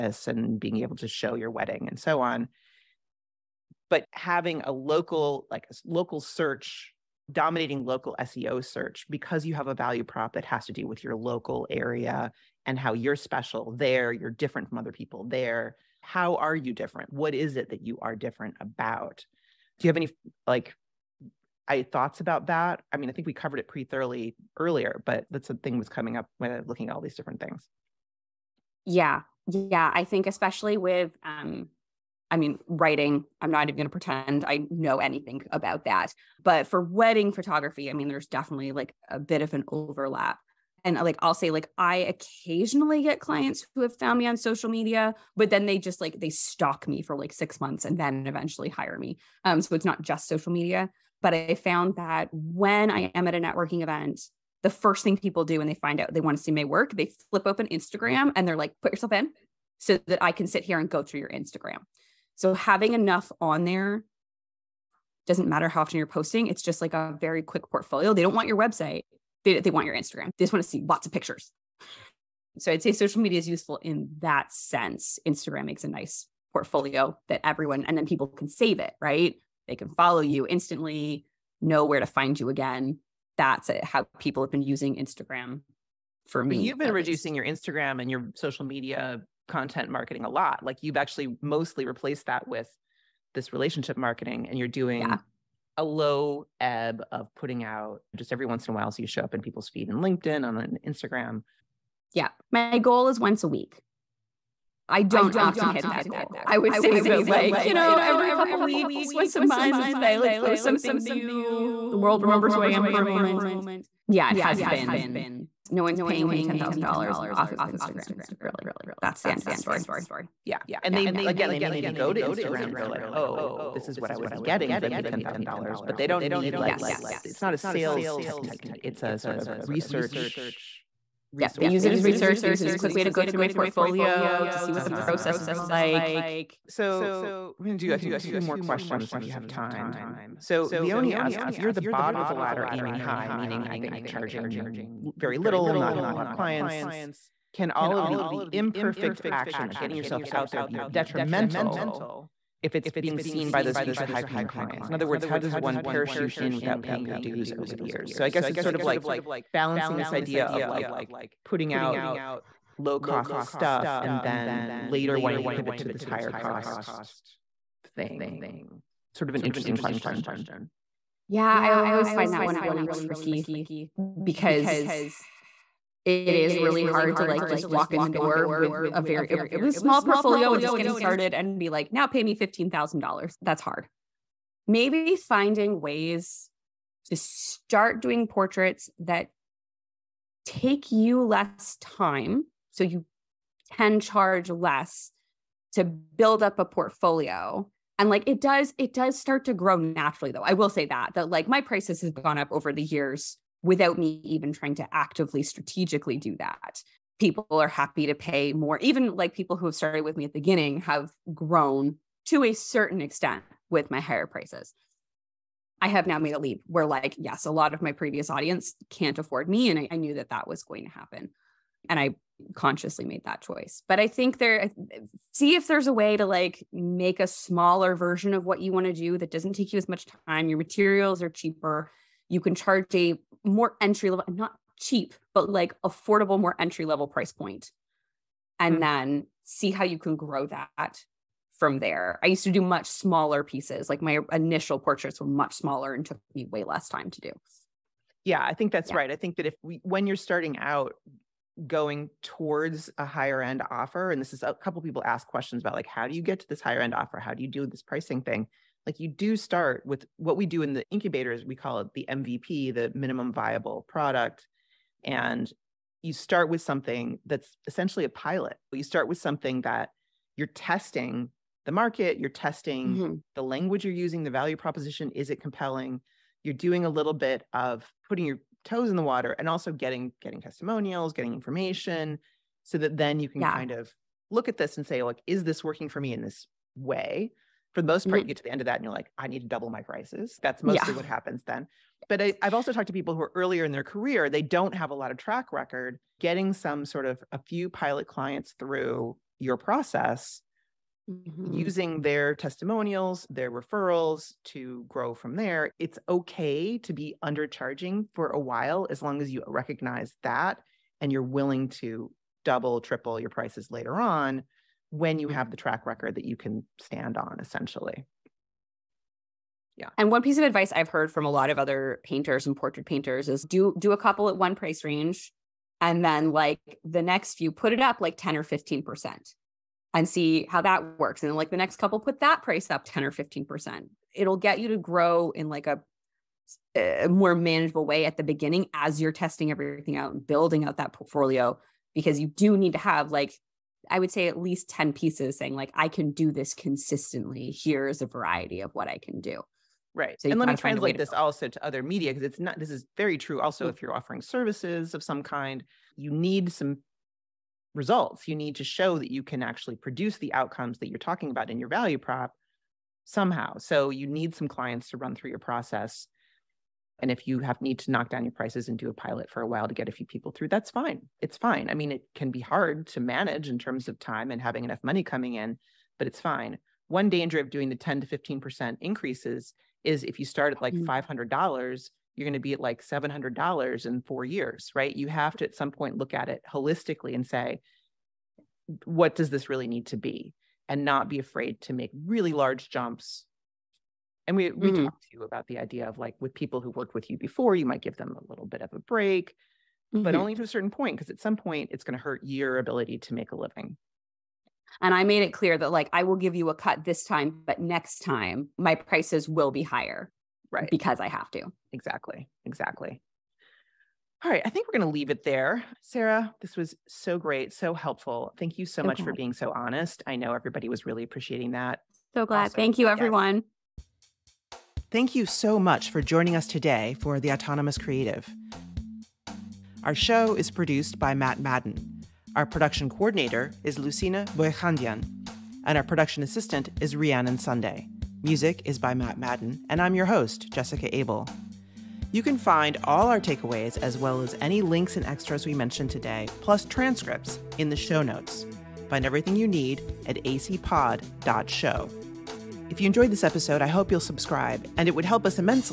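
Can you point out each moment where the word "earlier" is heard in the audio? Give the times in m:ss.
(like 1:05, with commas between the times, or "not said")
0:24, 4:53.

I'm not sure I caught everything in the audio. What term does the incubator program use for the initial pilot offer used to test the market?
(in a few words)
minimum viable product.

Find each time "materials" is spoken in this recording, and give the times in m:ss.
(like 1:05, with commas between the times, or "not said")
3:50.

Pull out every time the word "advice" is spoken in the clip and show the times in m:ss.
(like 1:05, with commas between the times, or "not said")
5:20.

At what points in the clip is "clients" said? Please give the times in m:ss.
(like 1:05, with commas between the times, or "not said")
0:43, 2:26, 2:34, 4:58, 6:04.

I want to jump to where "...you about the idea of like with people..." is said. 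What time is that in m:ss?
6:35.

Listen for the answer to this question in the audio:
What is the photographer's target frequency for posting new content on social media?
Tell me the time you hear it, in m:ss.
1:43.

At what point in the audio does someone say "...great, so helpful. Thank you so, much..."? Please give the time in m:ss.
6:57.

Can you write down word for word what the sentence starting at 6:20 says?
$500, you're going to be at like $700 in four years, right?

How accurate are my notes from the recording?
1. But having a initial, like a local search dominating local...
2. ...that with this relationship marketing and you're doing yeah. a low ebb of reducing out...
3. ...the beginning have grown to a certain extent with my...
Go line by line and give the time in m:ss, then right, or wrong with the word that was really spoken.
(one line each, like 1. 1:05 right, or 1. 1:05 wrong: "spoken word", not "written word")
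1. 0:03 wrong: "local", not "initial"
2. 1:32 wrong: "putting", not "reducing"
3. 3:30 right.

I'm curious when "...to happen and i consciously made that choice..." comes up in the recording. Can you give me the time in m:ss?
3:40.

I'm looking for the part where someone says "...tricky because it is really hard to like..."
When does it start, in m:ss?
2:52.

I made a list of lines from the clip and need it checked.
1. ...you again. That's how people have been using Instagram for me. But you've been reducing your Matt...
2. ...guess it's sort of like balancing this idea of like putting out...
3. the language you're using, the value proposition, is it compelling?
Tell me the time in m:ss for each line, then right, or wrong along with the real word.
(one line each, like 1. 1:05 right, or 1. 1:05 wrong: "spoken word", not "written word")
1. 1:22 wrong: "Instagram", not "Matt"
2. 2:38 right
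3. 4:33 right.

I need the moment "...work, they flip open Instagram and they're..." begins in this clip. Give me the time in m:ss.
0:56.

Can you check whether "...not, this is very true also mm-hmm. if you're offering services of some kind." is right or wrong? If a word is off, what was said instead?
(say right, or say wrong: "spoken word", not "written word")
right.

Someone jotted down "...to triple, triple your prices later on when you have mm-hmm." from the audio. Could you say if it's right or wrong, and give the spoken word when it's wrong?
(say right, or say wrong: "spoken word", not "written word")
wrong: "double", not "triple".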